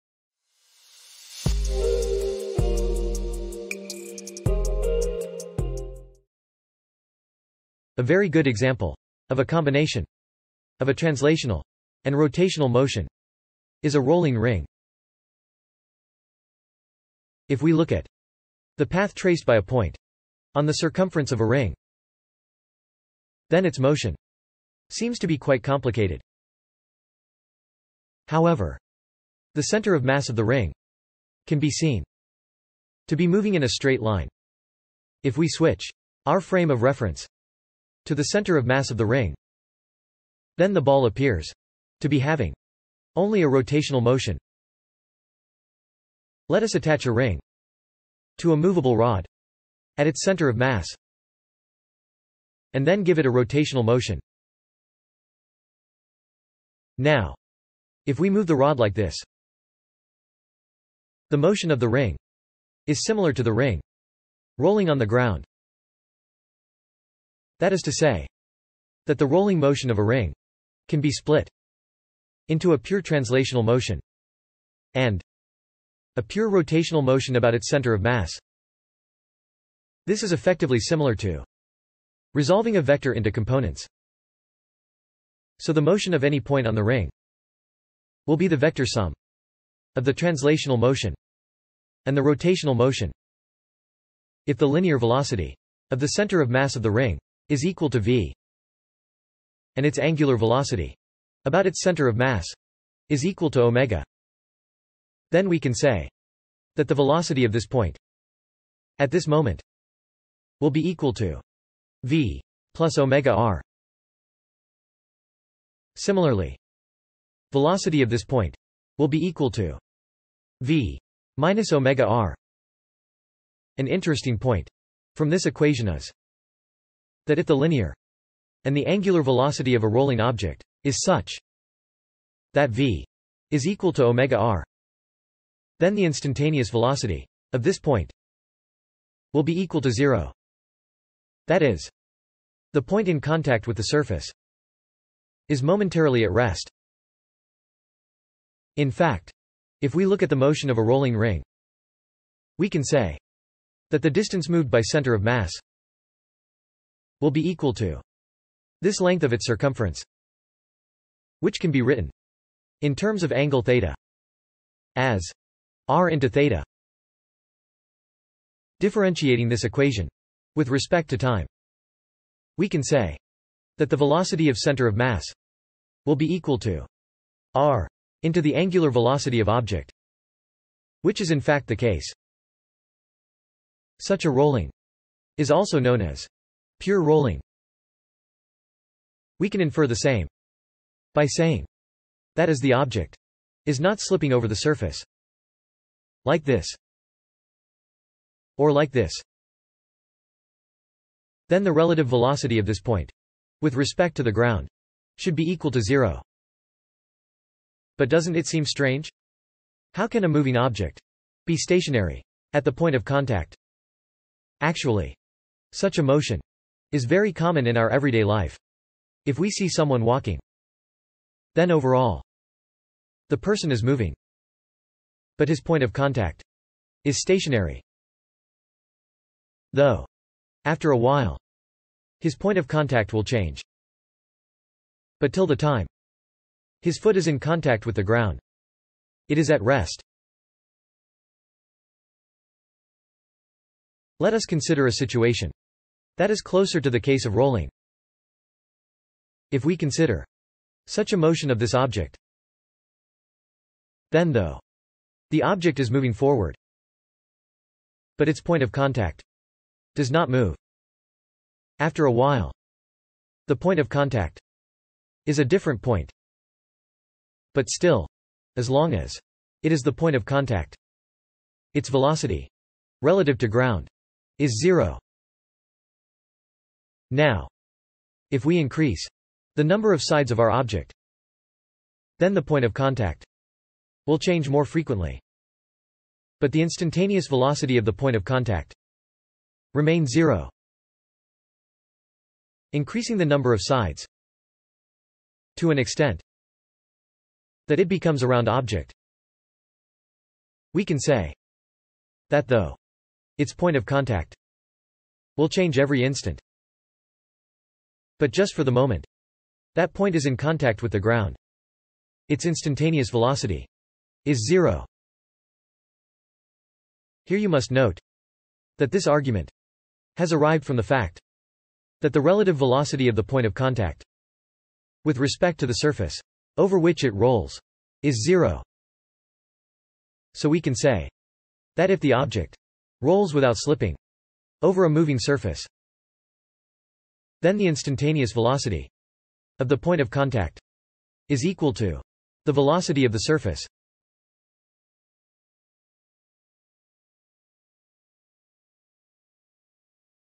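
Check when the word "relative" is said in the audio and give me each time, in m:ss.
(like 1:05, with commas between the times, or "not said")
3:21, 4:33, 5:22.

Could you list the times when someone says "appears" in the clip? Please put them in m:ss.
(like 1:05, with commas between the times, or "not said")
0:41.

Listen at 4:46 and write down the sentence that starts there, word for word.
But the instantaneous velocity of the point of contact remains zero.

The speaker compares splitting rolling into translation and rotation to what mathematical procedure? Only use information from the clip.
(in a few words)
resolving a vector into components.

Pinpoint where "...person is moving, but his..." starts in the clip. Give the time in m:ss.
3:43.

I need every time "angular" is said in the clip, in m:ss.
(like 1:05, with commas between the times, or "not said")
1:39, 2:08, 2:58.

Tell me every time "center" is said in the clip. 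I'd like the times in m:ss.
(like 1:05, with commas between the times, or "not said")
0:29, 0:38, 0:50, 1:17, 1:36, 1:41, 2:34, 2:54.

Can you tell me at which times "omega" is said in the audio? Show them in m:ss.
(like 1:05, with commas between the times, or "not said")
1:43, 1:52, 2:01, 2:14.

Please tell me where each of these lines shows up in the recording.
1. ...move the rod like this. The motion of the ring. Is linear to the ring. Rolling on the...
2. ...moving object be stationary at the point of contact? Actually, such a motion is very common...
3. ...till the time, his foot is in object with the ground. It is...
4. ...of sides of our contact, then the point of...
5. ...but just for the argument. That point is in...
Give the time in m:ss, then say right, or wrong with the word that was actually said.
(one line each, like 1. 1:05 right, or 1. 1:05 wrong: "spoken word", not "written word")
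1. 0:58 wrong: "similar", not "linear"
2. 3:30 right
3. 3:55 wrong: "contact", not "object"
4. 4:39 wrong: "object", not "contact"
5. 5:08 wrong: "moment", not "argument".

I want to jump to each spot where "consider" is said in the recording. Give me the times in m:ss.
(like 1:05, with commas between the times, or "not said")
4:04, 4:09.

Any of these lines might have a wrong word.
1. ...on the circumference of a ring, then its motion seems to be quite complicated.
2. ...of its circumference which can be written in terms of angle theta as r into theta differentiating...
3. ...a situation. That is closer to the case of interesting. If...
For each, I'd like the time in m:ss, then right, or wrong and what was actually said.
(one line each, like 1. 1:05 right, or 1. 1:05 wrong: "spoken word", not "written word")
1. 0:20 right
2. 2:39 right
3. 4:04 wrong: "rolling", not "interesting".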